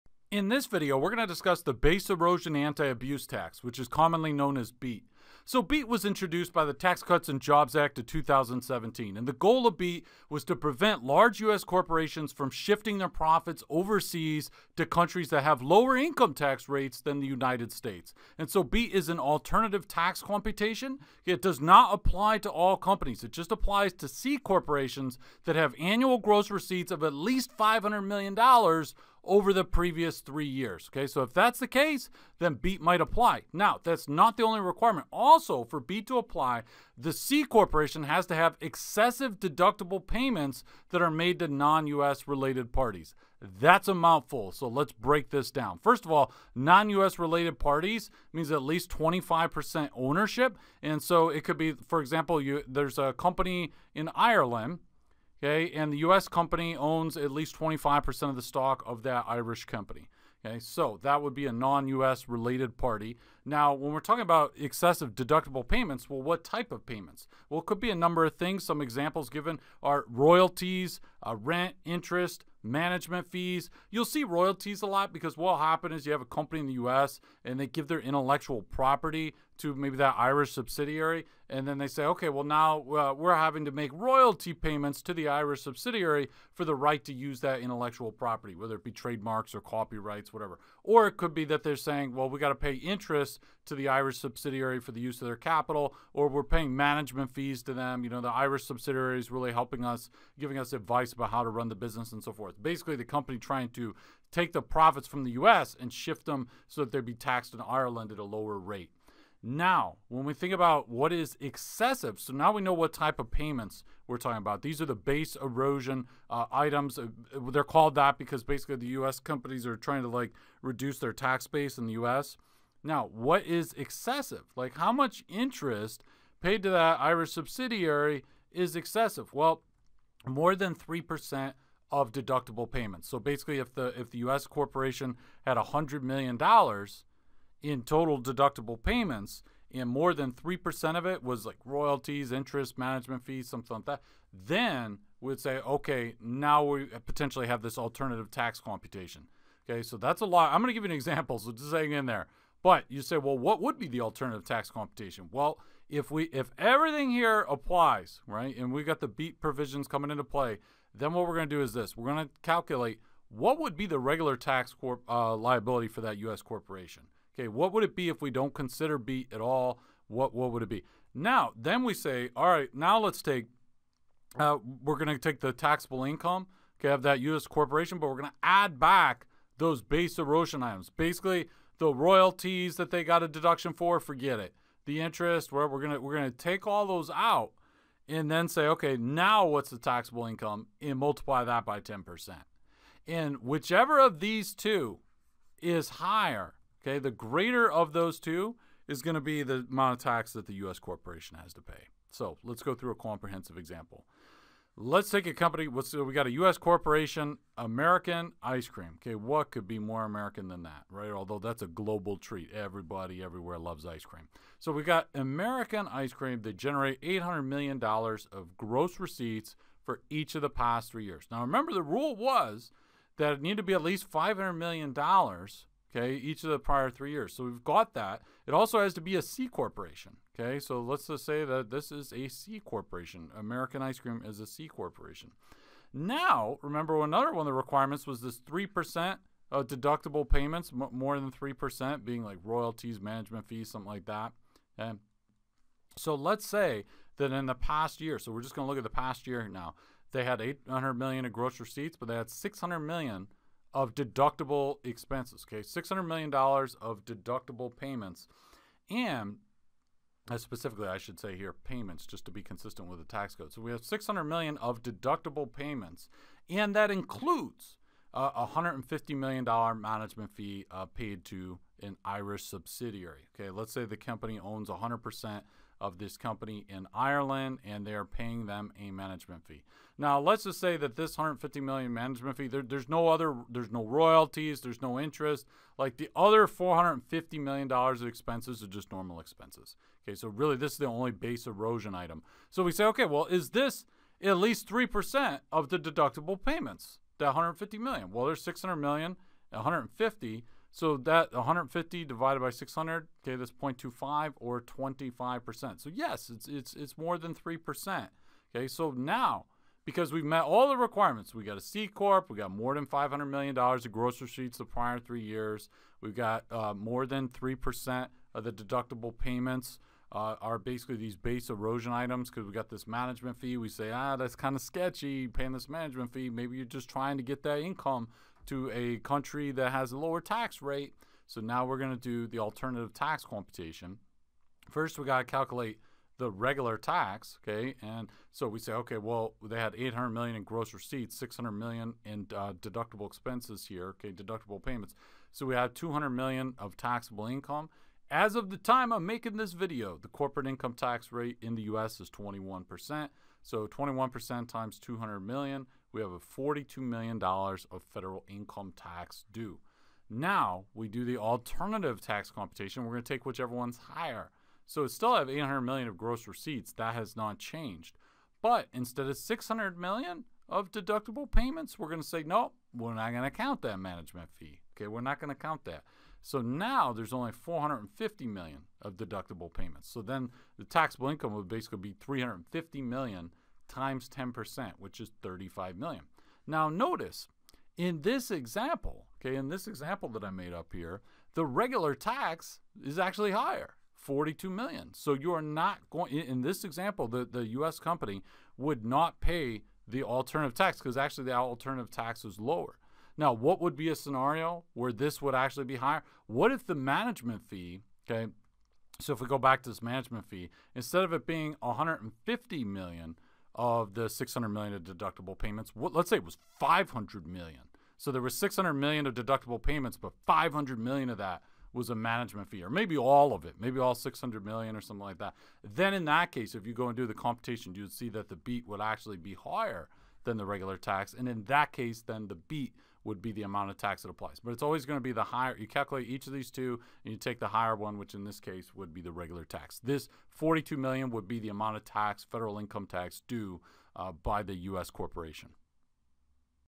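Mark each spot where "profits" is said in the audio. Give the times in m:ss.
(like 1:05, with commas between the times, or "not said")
0:13, 1:44.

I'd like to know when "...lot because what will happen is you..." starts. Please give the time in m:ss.
1:14.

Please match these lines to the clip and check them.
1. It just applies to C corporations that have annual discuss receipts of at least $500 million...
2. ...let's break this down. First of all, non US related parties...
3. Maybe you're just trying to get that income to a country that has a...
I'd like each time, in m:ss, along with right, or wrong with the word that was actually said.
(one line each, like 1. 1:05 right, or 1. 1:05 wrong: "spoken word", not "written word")
1. 0:23 wrong: "gross", not "discuss"
2. 0:44 right
3. 5:26 right.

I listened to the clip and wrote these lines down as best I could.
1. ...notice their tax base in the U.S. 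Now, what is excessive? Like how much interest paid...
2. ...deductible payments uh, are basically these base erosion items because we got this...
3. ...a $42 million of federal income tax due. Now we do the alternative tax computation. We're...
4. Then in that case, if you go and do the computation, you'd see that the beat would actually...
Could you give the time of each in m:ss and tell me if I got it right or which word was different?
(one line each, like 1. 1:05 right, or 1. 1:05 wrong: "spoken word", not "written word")
1. 2:00 wrong: "reduce", not "notice"
2. 5:18 right
3. 5:56 right
4. 7:05 right.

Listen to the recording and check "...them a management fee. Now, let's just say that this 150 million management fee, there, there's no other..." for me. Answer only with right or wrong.
right.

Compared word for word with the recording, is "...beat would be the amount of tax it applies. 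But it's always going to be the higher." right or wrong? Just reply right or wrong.
right.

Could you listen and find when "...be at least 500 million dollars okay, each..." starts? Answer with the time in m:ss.
3:43.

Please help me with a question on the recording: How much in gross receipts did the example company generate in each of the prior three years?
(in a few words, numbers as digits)
$800 million.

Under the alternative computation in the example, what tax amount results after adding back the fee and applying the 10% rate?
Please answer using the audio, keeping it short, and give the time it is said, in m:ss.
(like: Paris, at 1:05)
$35 million, at 6:25.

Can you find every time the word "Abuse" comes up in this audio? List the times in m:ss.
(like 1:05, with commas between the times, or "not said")
0:02.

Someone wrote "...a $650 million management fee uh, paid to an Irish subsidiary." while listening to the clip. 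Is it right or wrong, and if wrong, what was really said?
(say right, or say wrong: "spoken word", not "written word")
wrong: "150", not "650".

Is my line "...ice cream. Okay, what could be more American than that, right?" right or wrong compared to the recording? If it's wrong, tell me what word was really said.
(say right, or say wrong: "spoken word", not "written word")
right.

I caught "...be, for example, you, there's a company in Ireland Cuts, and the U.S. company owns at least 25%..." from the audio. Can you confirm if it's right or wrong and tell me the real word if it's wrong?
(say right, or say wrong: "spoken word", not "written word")
wrong: "Okay", not "Cuts".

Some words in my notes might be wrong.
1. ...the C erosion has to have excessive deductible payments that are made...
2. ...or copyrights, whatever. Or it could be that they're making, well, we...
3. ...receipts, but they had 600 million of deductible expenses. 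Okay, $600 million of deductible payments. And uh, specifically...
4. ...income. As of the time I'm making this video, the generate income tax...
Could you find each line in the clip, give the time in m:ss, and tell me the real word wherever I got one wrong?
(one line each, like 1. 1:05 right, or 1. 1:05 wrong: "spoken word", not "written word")
1. 0:36 wrong: "corporation", not "erosion"
2. 1:29 wrong: "saying", not "making"
3. 4:11 right
4. 5:47 wrong: "corporate", not "generate".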